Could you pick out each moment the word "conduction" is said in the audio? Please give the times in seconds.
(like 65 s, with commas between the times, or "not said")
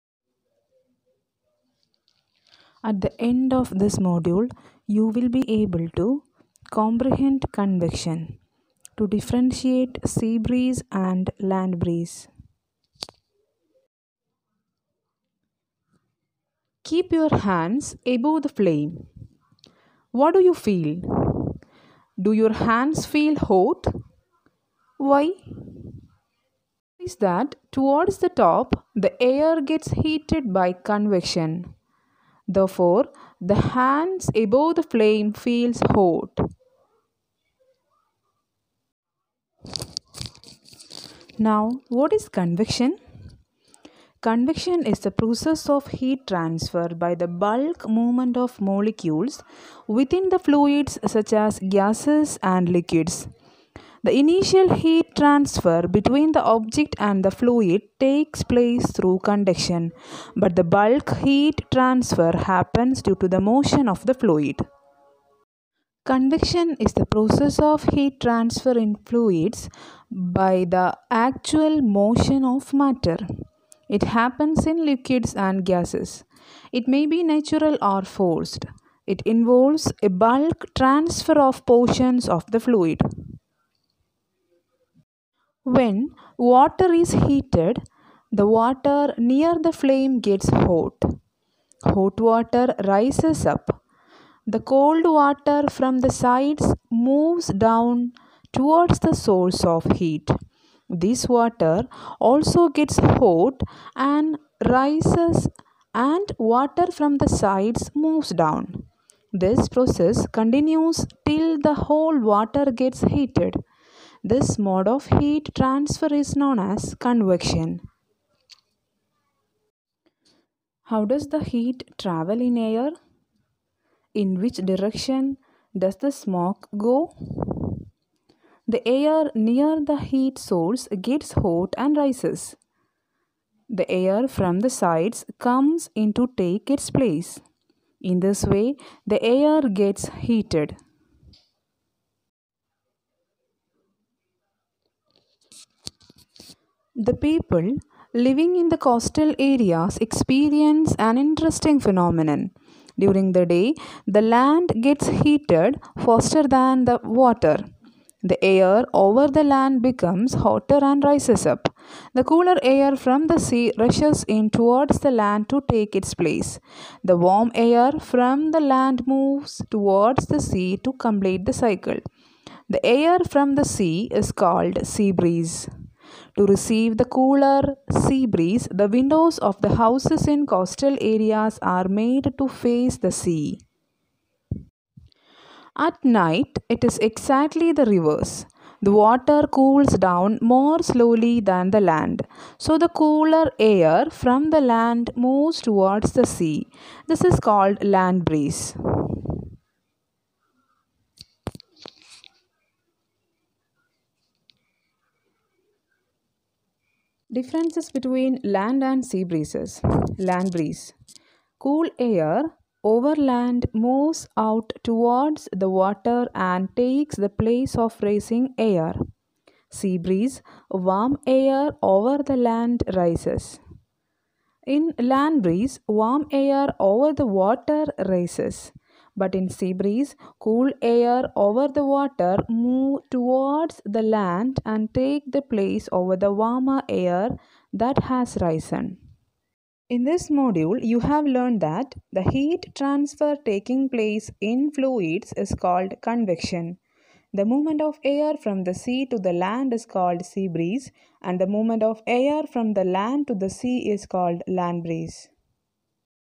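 59 s, 66 s.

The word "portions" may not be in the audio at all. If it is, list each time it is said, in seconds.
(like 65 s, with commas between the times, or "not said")
81 s.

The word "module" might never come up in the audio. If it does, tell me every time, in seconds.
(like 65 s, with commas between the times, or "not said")
3 s, 240 s.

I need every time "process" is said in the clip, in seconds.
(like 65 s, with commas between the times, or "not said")
45 s, 67 s, 109 s.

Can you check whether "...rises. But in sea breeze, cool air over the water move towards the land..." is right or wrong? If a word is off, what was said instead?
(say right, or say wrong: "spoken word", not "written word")
right.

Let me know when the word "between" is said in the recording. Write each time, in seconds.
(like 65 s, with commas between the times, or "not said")
55 s, 207 s.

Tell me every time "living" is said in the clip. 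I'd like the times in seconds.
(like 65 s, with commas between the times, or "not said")
148 s.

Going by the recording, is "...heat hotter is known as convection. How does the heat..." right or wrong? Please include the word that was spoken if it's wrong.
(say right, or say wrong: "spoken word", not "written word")
wrong: "transfer", not "hotter".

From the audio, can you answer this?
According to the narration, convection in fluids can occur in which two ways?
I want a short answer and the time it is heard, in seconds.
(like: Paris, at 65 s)
natural or forced, at 77 s.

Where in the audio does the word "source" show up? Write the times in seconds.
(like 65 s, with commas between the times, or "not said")
99 s, 130 s.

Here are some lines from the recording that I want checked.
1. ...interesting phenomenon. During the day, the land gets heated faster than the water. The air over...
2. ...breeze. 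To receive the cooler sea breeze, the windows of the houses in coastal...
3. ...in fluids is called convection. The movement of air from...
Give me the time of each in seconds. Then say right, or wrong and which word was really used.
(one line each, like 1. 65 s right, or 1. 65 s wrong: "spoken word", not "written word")
1. 151 s right
2. 175 s right
3. 244 s right.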